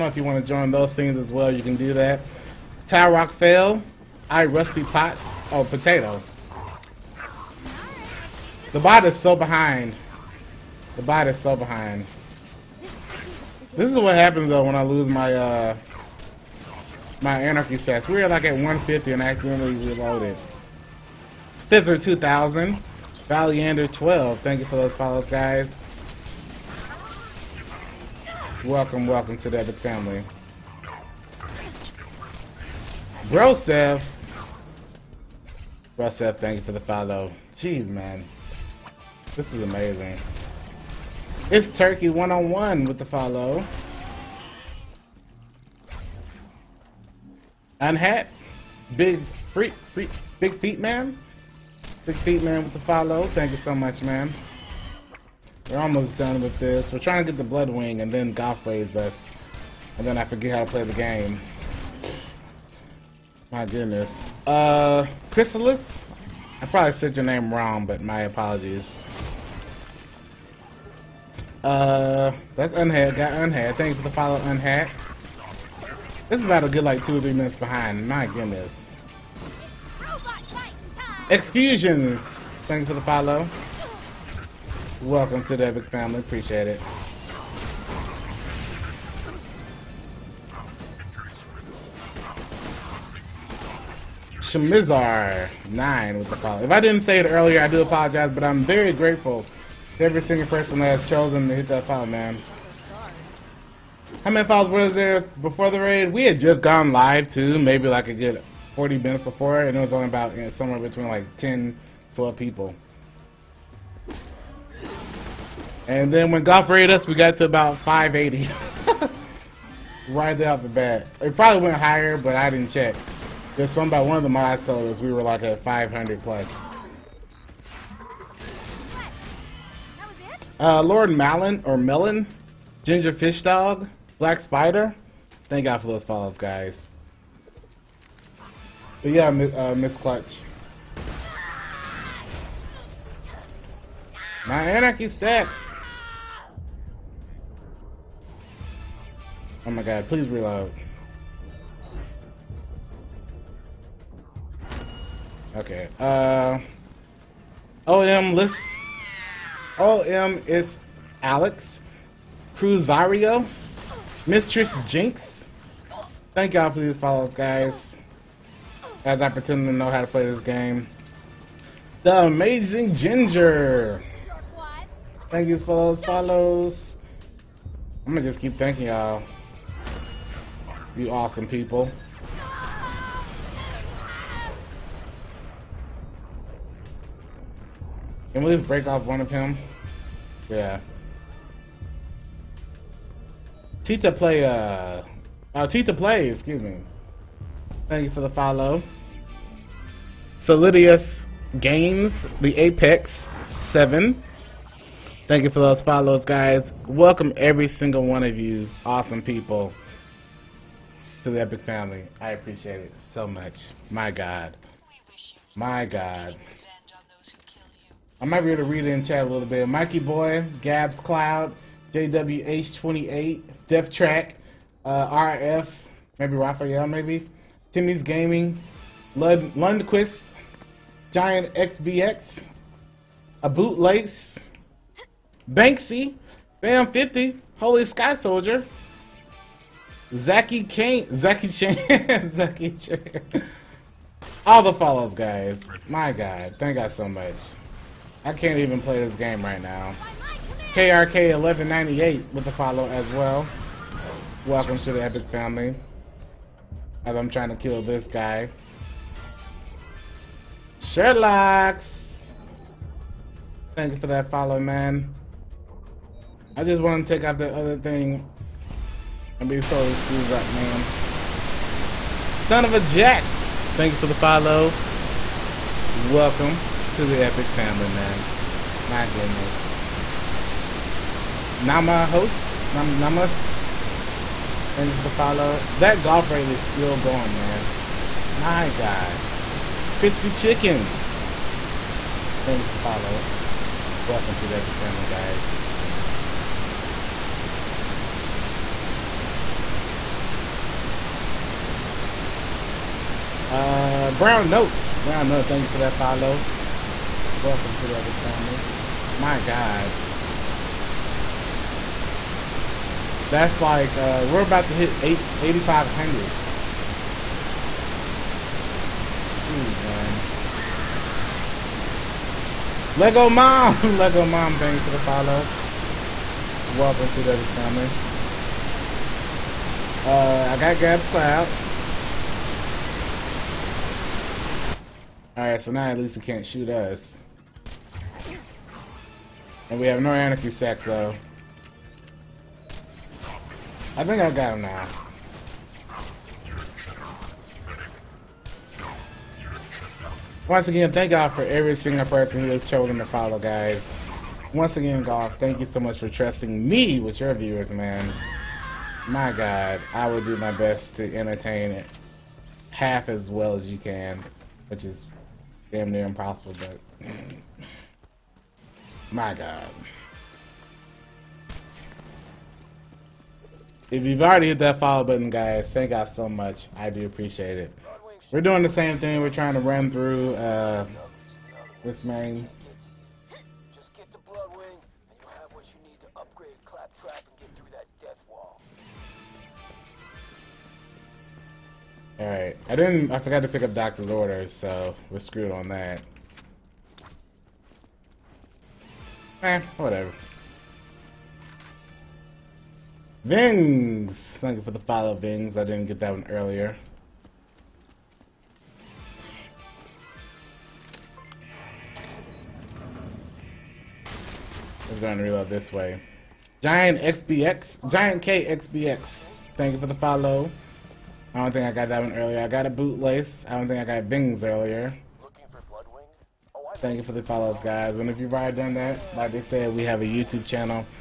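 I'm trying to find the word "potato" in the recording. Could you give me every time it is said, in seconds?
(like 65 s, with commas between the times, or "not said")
5 s.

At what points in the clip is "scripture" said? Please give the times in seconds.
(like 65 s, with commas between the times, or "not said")
not said.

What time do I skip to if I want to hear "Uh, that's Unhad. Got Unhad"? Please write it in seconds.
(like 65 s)
71 s.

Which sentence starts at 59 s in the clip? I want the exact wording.
And then I forget how to play the game.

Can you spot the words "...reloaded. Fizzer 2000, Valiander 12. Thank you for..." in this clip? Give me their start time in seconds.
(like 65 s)
19 s.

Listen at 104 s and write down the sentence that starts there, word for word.
How many follows was there before the raid?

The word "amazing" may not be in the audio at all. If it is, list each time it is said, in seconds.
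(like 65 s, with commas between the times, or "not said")
39 s, 172 s.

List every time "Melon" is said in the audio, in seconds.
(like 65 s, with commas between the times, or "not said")
131 s.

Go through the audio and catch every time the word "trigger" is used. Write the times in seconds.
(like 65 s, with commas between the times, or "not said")
not said.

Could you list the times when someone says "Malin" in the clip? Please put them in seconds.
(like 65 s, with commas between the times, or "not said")
131 s.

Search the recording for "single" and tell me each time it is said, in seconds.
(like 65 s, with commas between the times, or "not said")
100 s, 207 s, 351 s.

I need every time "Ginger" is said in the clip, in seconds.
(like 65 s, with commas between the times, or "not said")
132 s, 172 s.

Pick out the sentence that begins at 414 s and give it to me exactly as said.
Let's go ahead and reload this way.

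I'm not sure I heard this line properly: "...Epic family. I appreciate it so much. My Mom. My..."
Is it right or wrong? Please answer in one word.
wrong.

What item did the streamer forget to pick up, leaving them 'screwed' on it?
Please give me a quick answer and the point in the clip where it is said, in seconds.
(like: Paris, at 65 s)
Doctor's Orders, at 393 s.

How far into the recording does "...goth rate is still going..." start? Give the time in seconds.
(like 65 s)
286 s.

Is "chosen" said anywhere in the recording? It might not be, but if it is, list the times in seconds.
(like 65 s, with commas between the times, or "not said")
101 s, 352 s.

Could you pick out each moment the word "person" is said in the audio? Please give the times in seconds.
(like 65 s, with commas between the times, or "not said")
100 s, 352 s.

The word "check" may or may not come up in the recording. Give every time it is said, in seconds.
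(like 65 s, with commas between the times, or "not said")
122 s.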